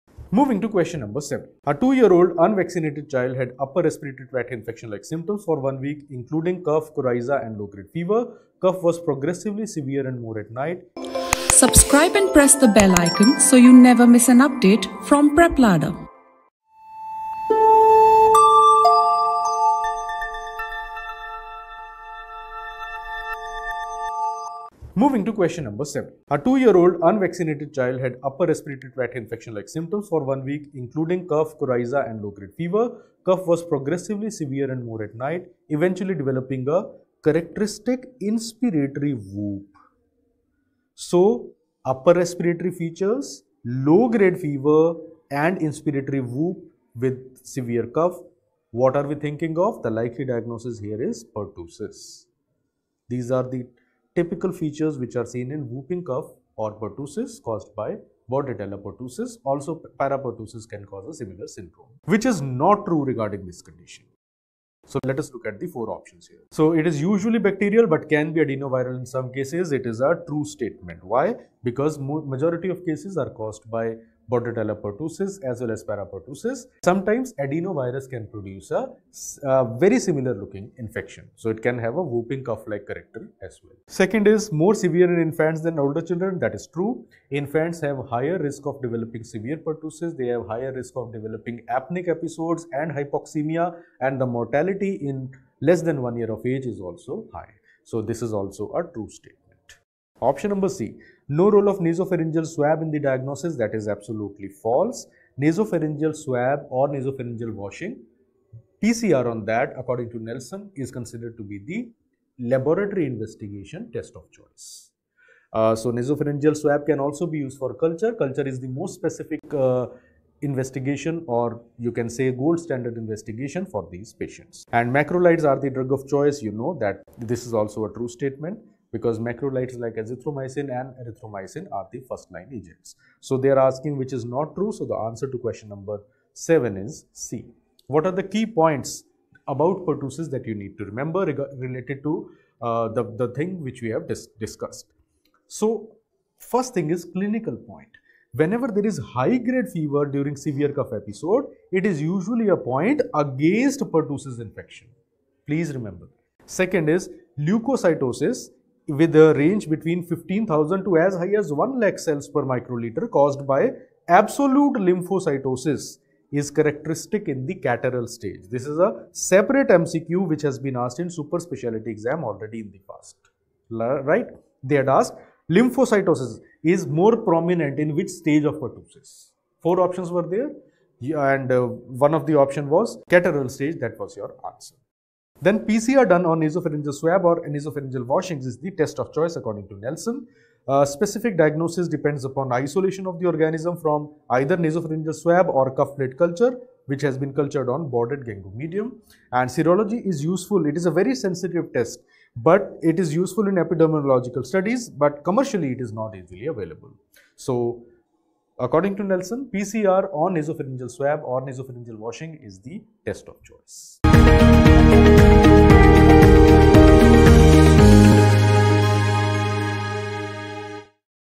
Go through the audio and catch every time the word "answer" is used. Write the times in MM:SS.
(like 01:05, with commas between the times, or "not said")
02:14, 03:04.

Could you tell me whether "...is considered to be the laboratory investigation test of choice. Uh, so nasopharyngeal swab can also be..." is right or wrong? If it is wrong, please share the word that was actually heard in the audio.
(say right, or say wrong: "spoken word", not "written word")
right.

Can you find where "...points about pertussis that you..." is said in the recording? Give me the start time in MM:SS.
02:18.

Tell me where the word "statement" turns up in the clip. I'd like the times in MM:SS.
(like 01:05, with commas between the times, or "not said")
01:10, 01:39, 02:08.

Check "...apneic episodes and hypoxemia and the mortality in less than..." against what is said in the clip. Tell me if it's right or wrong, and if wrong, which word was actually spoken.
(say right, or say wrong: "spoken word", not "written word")
right.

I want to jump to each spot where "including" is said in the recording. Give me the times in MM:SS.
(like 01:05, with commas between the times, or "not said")
00:06, 00:30.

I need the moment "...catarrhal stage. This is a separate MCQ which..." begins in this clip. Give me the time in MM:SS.
02:47.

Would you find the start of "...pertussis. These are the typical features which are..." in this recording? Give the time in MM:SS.
00:51.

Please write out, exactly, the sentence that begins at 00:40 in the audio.
So, upper respiratory features, low-grade fever and inspiratory whoop with severe cough.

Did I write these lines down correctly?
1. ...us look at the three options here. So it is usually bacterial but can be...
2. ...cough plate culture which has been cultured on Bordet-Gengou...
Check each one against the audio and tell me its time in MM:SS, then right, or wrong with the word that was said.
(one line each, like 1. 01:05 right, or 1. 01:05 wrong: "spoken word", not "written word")
1. 01:05 wrong: "four", not "three"
2. 03:15 right.